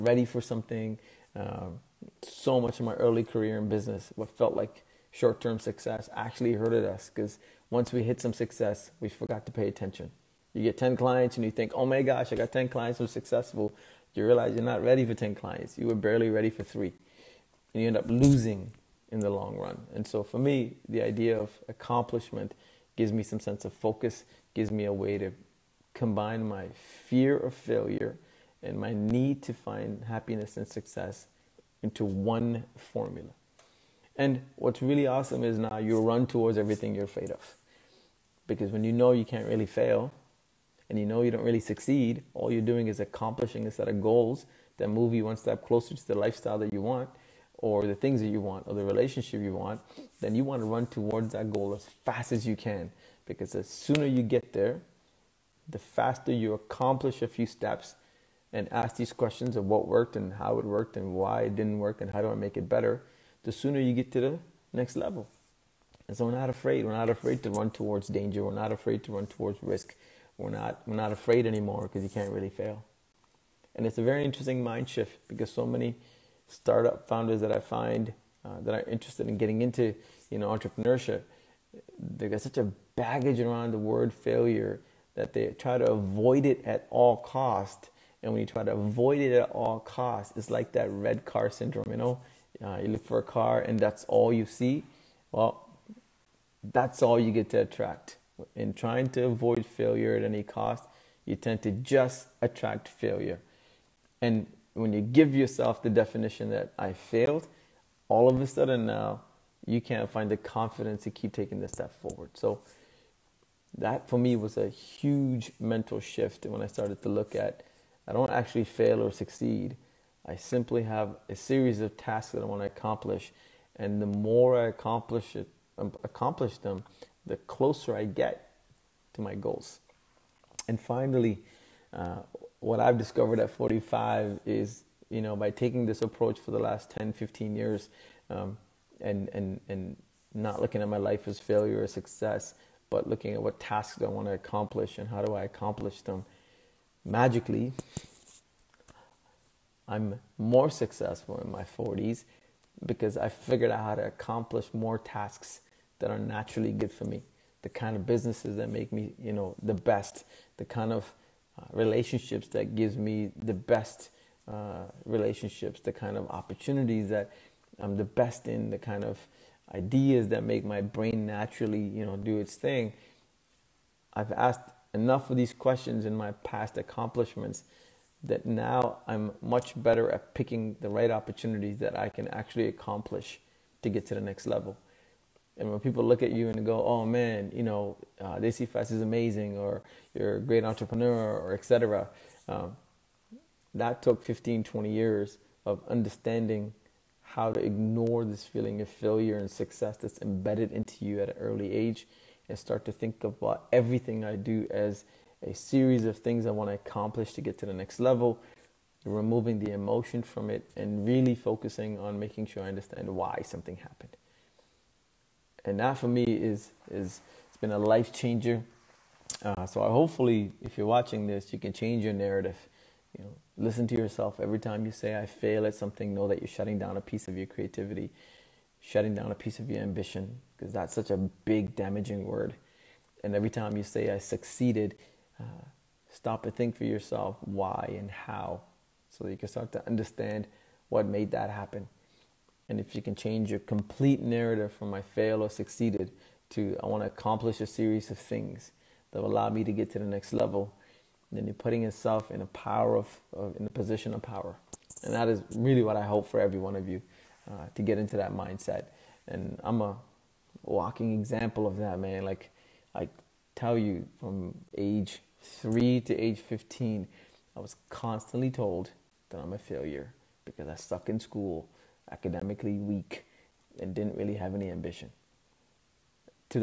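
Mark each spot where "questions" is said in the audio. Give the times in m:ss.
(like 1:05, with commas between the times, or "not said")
0:59, 2:55.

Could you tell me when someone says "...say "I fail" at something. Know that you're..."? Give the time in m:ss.
3:44.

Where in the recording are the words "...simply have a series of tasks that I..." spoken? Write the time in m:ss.
2:00.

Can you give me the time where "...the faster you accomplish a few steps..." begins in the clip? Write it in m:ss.
0:55.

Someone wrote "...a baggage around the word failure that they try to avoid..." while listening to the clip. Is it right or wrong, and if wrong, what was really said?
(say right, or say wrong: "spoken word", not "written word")
right.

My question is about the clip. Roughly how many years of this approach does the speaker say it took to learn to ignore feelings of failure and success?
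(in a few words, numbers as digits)
15 to 20 years.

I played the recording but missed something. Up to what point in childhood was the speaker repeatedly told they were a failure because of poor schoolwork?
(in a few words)
age 15.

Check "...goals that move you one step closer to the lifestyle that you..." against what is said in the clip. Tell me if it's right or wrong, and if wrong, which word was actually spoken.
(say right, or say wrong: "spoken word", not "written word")
right.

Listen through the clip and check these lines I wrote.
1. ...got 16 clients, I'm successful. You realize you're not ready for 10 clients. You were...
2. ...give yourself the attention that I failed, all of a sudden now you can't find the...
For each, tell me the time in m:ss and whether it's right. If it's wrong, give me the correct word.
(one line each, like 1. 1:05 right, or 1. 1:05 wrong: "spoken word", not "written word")
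1. 0:12 wrong: "10", not "16"
2. 1:45 wrong: "definition", not "attention".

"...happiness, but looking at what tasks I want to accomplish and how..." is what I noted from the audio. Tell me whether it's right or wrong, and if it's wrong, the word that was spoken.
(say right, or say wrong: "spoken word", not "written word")
wrong: "success", not "happiness".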